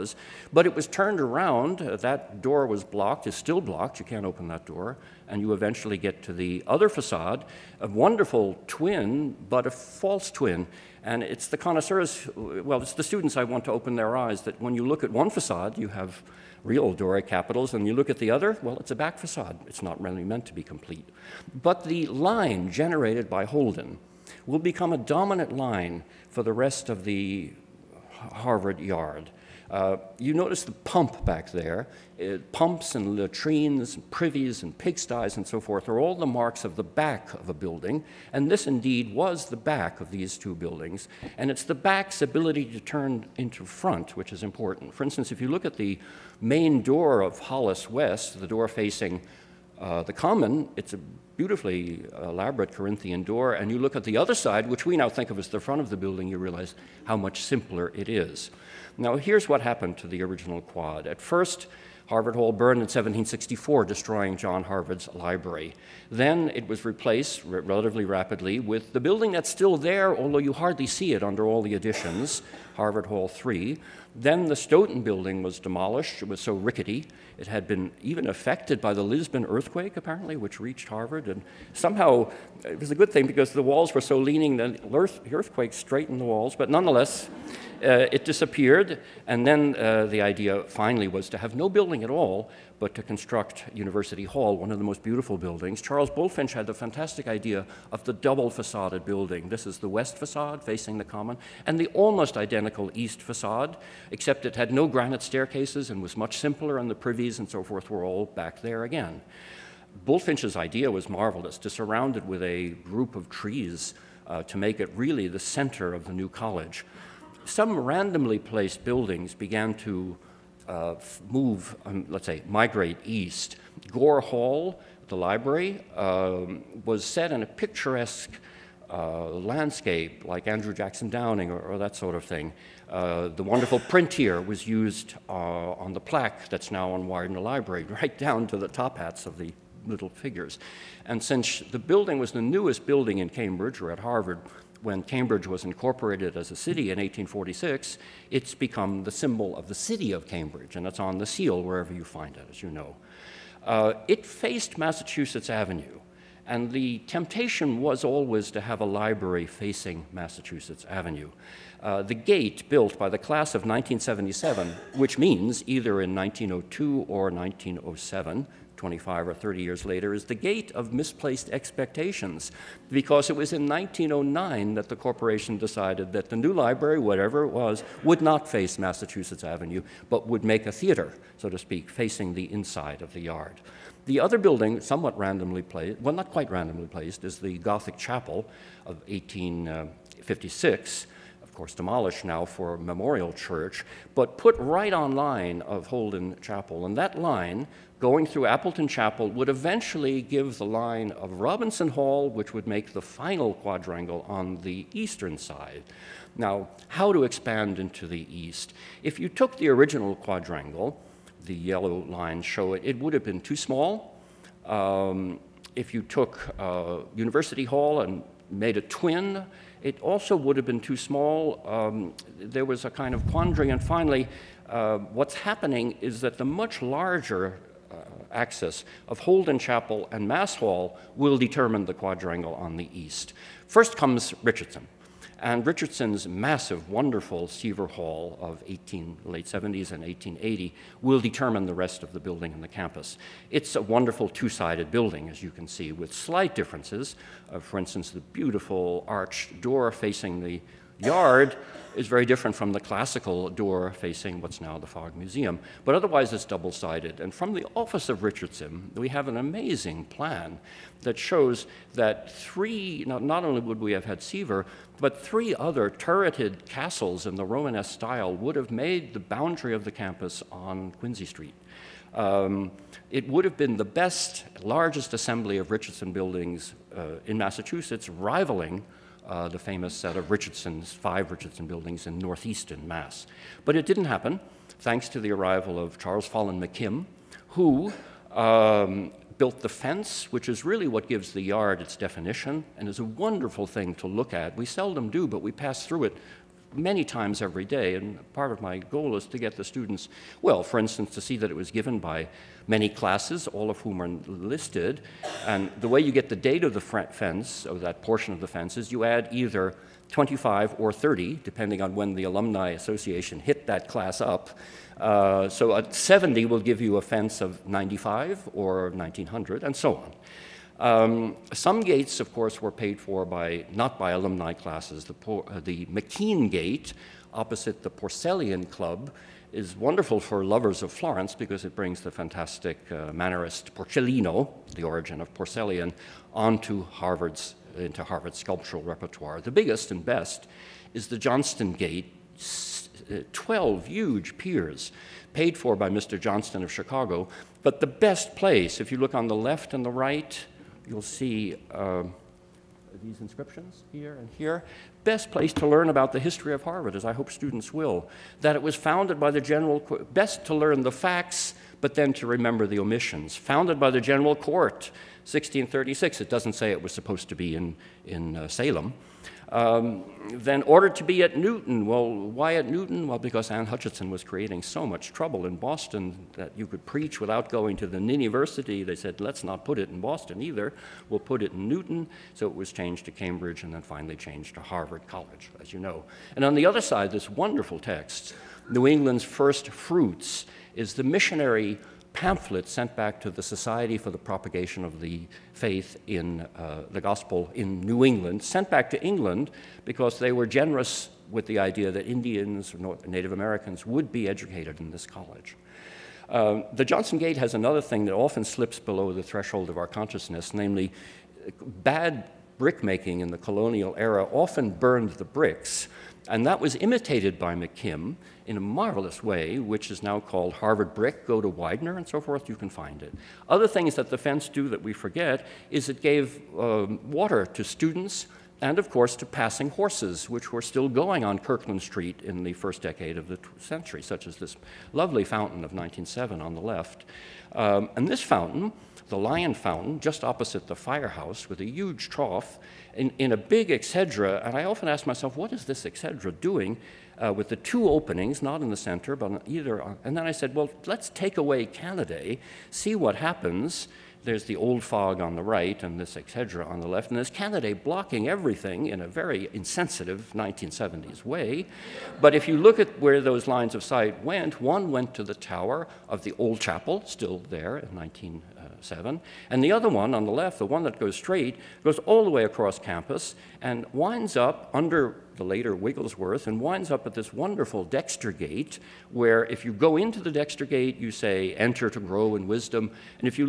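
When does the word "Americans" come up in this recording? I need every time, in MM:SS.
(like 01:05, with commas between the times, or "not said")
06:43.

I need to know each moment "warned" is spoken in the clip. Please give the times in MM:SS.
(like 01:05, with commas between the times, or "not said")
not said.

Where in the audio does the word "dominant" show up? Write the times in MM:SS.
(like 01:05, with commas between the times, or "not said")
00:24.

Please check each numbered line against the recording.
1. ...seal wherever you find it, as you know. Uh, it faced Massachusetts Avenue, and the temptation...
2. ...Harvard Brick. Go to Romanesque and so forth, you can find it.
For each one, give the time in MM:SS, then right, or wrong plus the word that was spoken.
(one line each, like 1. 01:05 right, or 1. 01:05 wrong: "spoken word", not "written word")
1. 02:31 right
2. 07:00 wrong: "Widener", not "Romanesque".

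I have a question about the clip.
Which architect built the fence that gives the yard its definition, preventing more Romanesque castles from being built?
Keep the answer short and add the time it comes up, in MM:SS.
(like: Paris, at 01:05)
Charles Follen McKim, at 04:45.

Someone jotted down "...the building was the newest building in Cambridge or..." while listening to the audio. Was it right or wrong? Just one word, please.
right.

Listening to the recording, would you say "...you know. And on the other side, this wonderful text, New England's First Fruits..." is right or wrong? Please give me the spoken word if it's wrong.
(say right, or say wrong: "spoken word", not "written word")
right.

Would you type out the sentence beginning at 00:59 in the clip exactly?
Now, here's what happened to the original quad.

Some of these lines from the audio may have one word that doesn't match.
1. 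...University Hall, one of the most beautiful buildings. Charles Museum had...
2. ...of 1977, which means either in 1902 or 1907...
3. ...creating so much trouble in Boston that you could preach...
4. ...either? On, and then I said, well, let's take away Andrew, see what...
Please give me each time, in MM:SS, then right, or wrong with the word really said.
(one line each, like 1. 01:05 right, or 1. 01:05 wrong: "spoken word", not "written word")
1. 01:33 wrong: "Bulfinch", not "Museum"
2. 02:43 right
3. 06:14 right
4. 07:29 wrong: "Canaday", not "Andrew".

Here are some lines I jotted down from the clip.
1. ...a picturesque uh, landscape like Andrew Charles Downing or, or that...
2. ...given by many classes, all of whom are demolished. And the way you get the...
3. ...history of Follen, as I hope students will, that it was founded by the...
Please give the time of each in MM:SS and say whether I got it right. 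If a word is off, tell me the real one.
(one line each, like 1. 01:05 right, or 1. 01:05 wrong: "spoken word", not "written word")
1. 02:07 wrong: "Jackson", not "Charles"
2. 05:01 wrong: "listed", not "demolished"
3. 05:56 wrong: "Harvard", not "Follen".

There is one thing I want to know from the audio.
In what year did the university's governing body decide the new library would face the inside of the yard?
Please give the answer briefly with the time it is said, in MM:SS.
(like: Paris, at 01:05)
1909, at 02:53.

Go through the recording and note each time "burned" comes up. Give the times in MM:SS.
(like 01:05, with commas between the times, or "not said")
01:02, 06:54.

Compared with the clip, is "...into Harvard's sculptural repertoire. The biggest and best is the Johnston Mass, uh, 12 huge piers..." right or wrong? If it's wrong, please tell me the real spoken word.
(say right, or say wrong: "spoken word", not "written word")
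wrong: "Gate", not "Mass".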